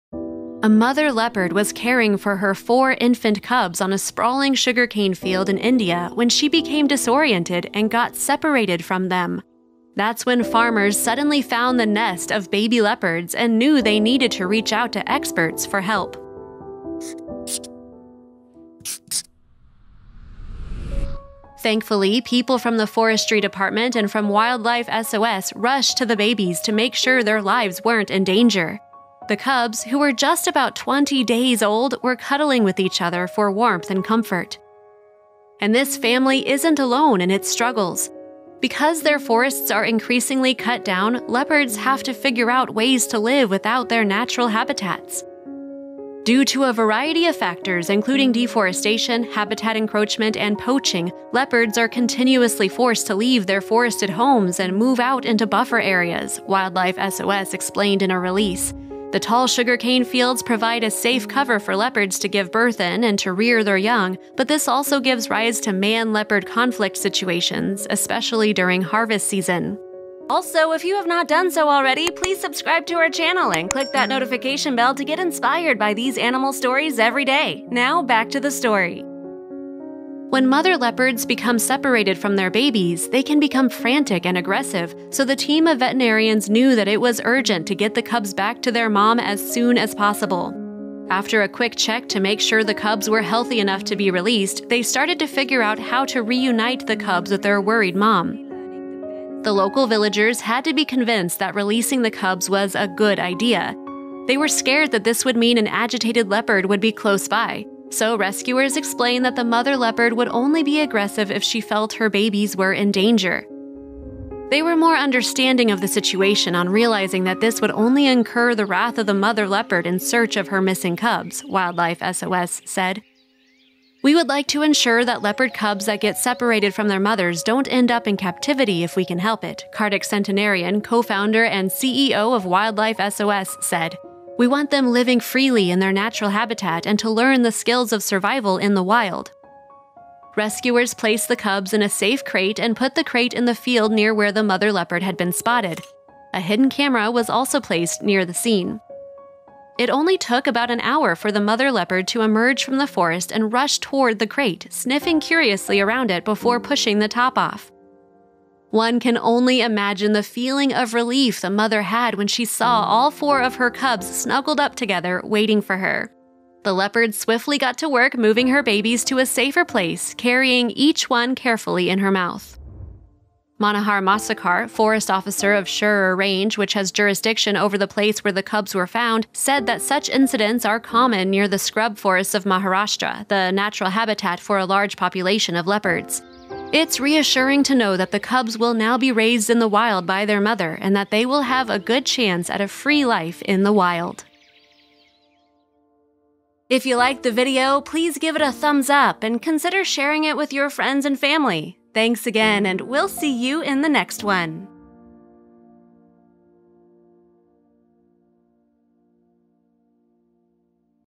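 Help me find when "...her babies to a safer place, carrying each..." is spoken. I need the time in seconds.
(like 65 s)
168 s.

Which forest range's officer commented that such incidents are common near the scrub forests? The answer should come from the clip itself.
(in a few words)
Shirur Range.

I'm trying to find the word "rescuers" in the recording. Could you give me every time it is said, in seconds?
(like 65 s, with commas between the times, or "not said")
108 s, 140 s.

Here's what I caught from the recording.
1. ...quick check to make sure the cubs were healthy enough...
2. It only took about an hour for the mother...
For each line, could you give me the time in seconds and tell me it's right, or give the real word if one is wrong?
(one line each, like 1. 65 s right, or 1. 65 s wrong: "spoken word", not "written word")
1. 91 s right
2. 149 s right.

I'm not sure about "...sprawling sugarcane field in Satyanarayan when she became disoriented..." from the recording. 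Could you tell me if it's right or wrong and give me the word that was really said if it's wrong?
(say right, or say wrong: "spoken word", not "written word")
wrong: "India", not "Satyanarayan".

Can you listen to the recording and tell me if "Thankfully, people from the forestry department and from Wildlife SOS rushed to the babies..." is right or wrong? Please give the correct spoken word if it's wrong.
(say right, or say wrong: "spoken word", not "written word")
right.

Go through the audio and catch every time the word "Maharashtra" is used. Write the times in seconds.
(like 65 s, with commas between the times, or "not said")
182 s.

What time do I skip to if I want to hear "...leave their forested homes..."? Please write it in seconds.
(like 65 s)
53 s.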